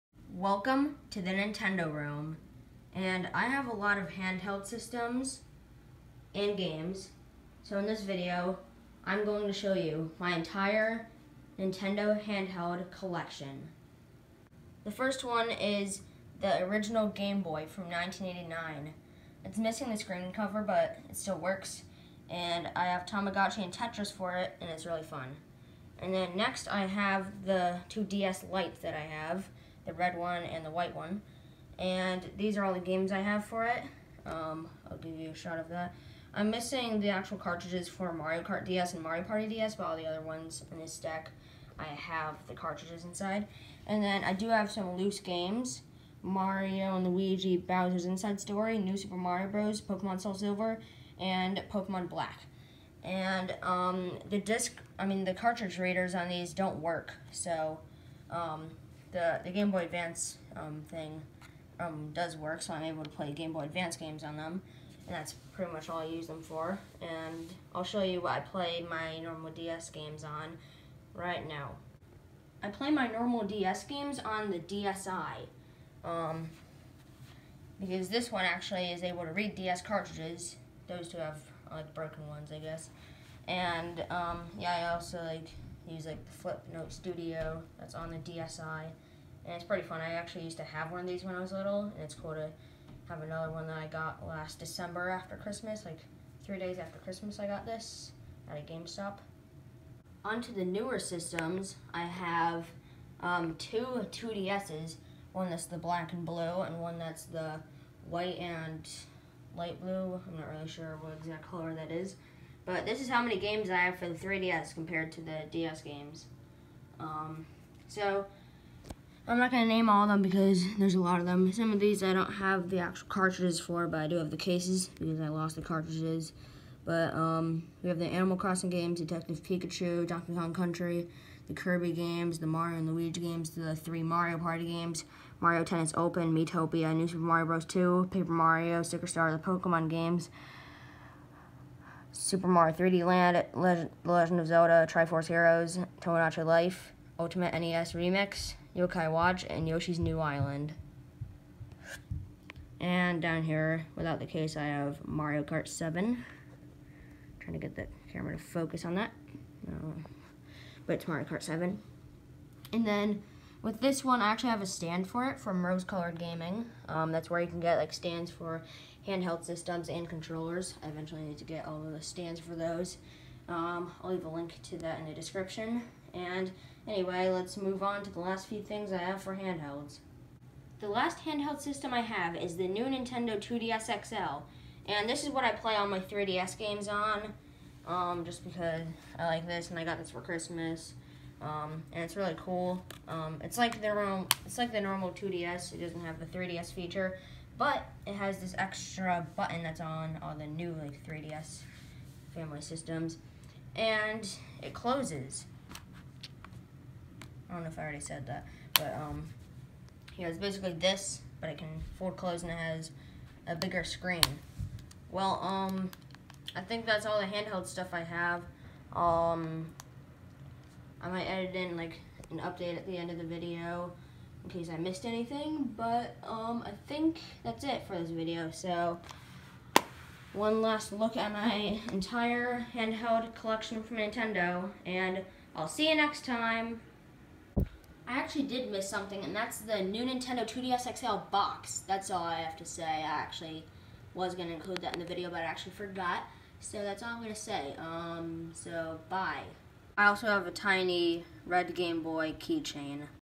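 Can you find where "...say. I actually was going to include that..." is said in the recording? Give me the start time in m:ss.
4:02.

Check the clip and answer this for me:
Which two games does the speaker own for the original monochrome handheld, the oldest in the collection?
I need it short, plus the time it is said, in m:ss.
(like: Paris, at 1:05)
Tamagotchi and Tetris, at 0:23.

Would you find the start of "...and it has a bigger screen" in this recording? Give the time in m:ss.
3:32.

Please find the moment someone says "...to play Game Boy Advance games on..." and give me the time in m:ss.
1:03.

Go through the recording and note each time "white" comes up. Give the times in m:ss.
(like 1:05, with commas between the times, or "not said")
0:30, 1:48.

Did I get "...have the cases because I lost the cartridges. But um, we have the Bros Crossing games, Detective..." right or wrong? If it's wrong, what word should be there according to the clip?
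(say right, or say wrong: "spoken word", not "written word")
wrong: "Animal", not "Bros".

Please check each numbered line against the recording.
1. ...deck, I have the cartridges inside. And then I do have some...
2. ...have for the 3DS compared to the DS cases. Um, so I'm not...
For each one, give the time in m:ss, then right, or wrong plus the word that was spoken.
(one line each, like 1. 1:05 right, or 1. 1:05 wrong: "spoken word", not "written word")
1. 0:40 right
2. 1:53 wrong: "games", not "cases".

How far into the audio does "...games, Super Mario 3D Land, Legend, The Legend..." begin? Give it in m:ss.
2:19.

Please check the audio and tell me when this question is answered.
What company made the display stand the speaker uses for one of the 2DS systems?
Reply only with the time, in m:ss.
2:45.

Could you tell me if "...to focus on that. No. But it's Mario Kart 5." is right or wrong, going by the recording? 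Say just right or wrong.
wrong.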